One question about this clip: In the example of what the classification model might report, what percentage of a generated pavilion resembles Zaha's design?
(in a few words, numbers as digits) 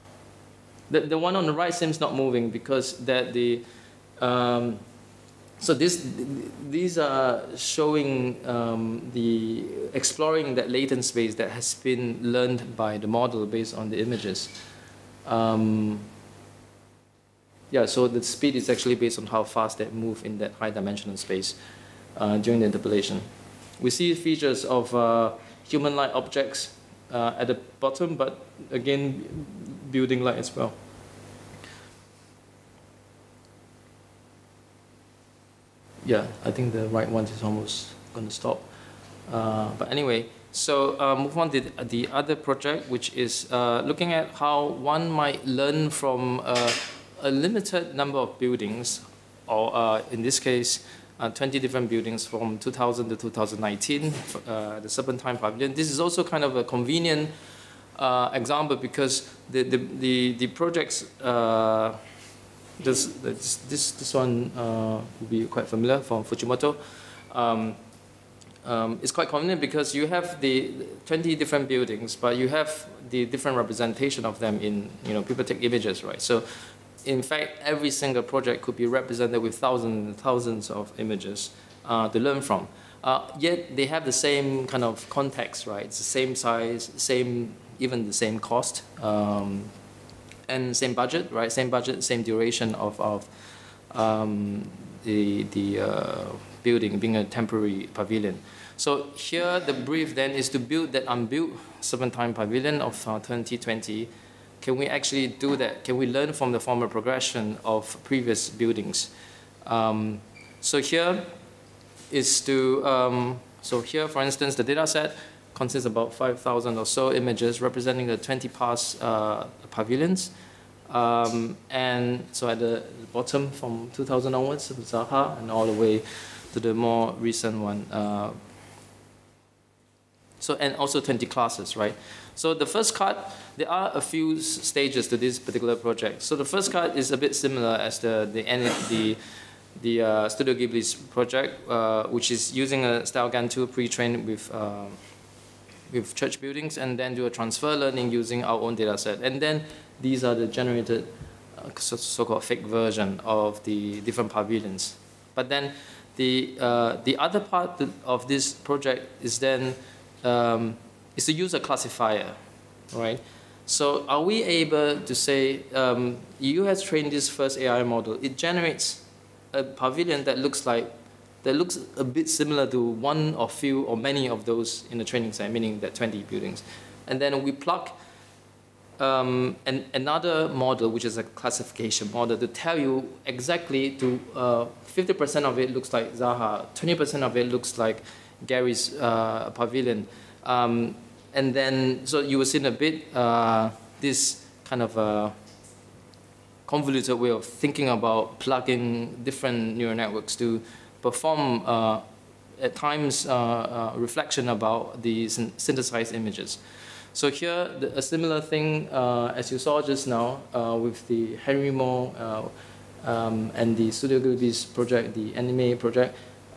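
50%.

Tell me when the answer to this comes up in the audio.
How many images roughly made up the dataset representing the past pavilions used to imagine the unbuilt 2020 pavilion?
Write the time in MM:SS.
01:56.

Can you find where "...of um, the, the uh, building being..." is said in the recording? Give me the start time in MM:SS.
01:32.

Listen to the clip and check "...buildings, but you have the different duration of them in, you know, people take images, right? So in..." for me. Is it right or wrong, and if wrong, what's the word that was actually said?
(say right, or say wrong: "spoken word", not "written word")
wrong: "representation", not "duration".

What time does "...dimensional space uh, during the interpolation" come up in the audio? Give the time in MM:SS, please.
00:20.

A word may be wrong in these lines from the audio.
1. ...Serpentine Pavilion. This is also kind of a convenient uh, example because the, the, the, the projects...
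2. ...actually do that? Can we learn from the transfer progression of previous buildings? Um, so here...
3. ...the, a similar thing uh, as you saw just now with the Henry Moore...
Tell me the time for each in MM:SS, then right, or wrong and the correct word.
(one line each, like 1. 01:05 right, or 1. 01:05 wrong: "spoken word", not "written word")
1. 00:54 right
2. 01:44 wrong: "former", not "transfer"
3. 03:27 right.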